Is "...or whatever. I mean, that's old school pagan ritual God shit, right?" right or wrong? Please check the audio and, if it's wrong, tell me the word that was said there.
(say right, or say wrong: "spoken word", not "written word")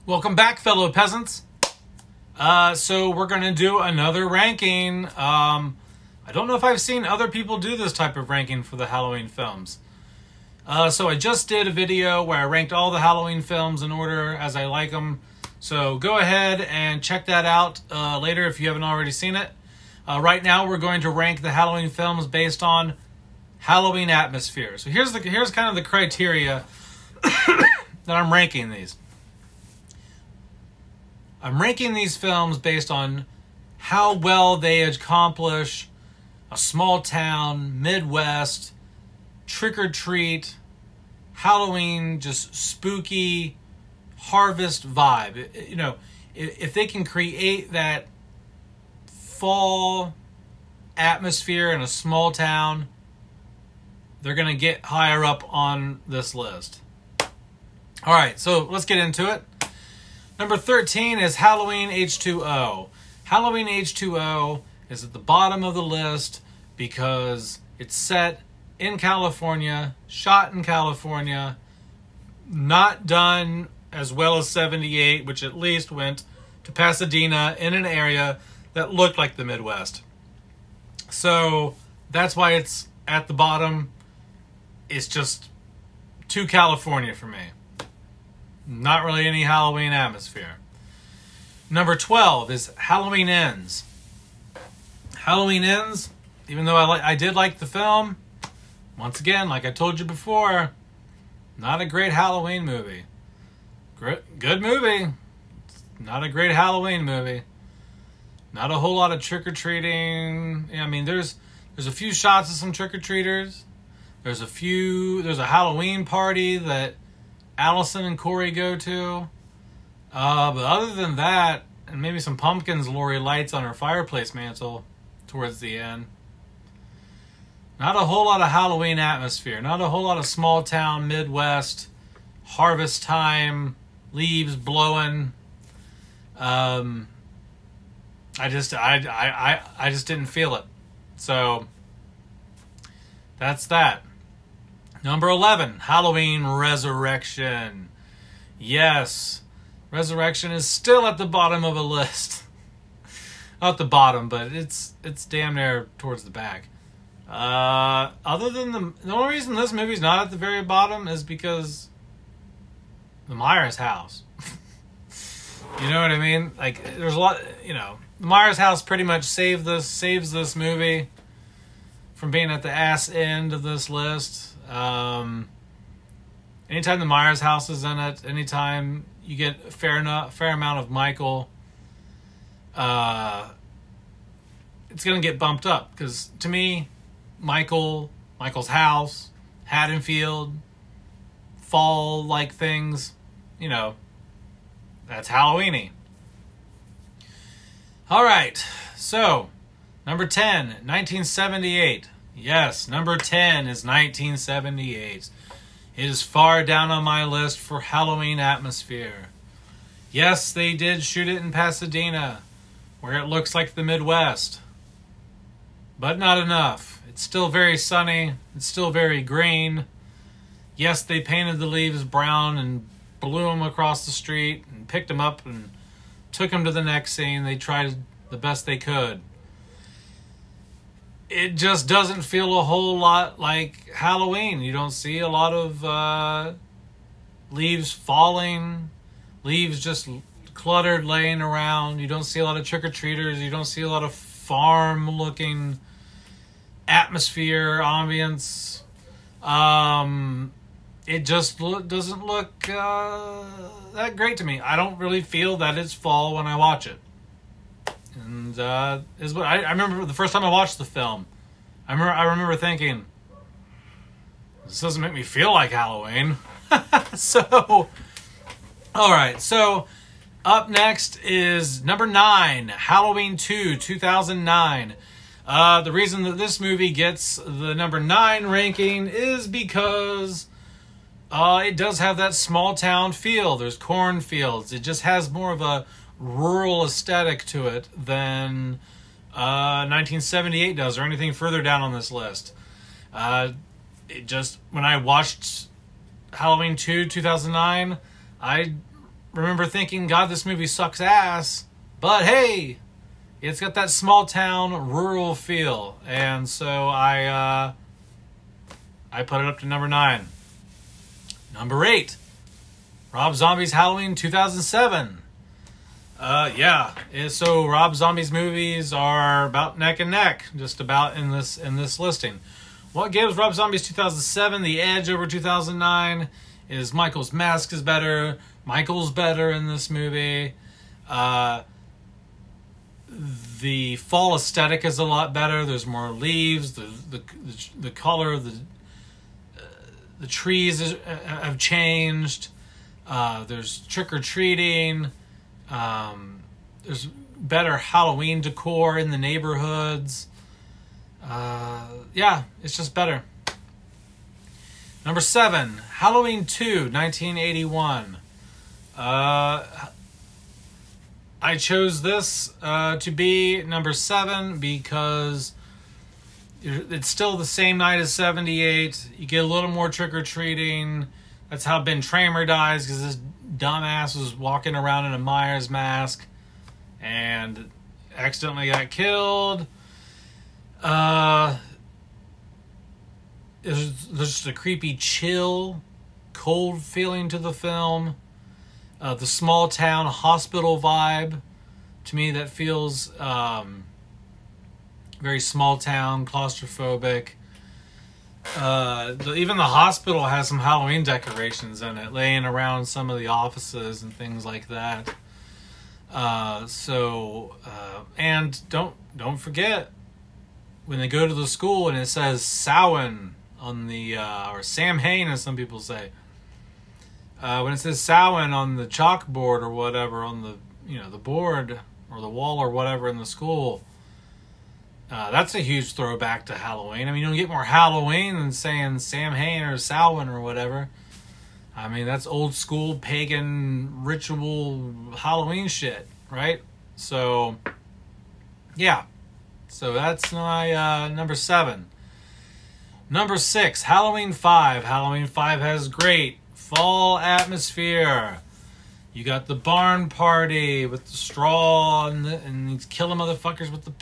wrong: "Halloween", not "God".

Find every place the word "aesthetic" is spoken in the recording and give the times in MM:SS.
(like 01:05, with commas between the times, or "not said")
04:46, 05:34.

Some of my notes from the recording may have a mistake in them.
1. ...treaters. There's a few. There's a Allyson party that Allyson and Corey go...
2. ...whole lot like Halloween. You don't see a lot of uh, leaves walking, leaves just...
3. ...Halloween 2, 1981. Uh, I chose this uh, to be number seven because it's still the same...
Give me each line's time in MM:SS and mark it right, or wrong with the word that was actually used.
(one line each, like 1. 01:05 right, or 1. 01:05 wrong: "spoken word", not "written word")
1. 01:52 wrong: "Halloween", not "Allyson"
2. 03:52 wrong: "falling", not "walking"
3. 05:55 right.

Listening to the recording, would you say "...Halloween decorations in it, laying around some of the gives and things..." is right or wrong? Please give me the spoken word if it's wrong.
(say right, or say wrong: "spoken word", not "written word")
wrong: "offices", not "gives".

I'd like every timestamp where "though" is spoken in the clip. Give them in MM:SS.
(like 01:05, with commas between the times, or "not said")
01:36.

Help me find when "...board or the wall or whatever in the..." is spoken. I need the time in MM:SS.
07:01.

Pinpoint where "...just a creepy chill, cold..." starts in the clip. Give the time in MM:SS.
06:24.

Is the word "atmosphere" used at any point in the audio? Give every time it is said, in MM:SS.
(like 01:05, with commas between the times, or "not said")
00:24, 00:50, 01:29, 02:08, 03:28, 04:06, 07:27.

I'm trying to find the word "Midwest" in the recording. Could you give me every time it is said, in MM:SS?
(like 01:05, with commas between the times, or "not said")
00:37, 01:19, 02:11, 03:33.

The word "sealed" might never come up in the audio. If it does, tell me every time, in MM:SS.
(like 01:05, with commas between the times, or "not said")
not said.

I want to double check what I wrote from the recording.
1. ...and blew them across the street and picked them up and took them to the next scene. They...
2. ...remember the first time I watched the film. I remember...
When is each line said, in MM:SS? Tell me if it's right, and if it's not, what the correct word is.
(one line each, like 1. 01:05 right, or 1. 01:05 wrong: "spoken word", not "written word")
1. 03:42 right
2. 04:19 right.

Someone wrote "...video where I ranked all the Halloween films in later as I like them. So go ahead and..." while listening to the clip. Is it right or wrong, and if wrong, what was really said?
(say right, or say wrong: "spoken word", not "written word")
wrong: "order", not "later".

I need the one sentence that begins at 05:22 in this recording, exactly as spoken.
What gives Rob Zombie's 2007 the edge over 2009 is Michael's mask is better.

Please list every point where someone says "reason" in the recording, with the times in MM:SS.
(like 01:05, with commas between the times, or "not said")
02:39, 04:35.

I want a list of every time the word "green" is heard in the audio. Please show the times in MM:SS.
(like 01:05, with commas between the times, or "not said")
03:39.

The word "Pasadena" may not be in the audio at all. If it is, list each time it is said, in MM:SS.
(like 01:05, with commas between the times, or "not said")
01:16, 03:31.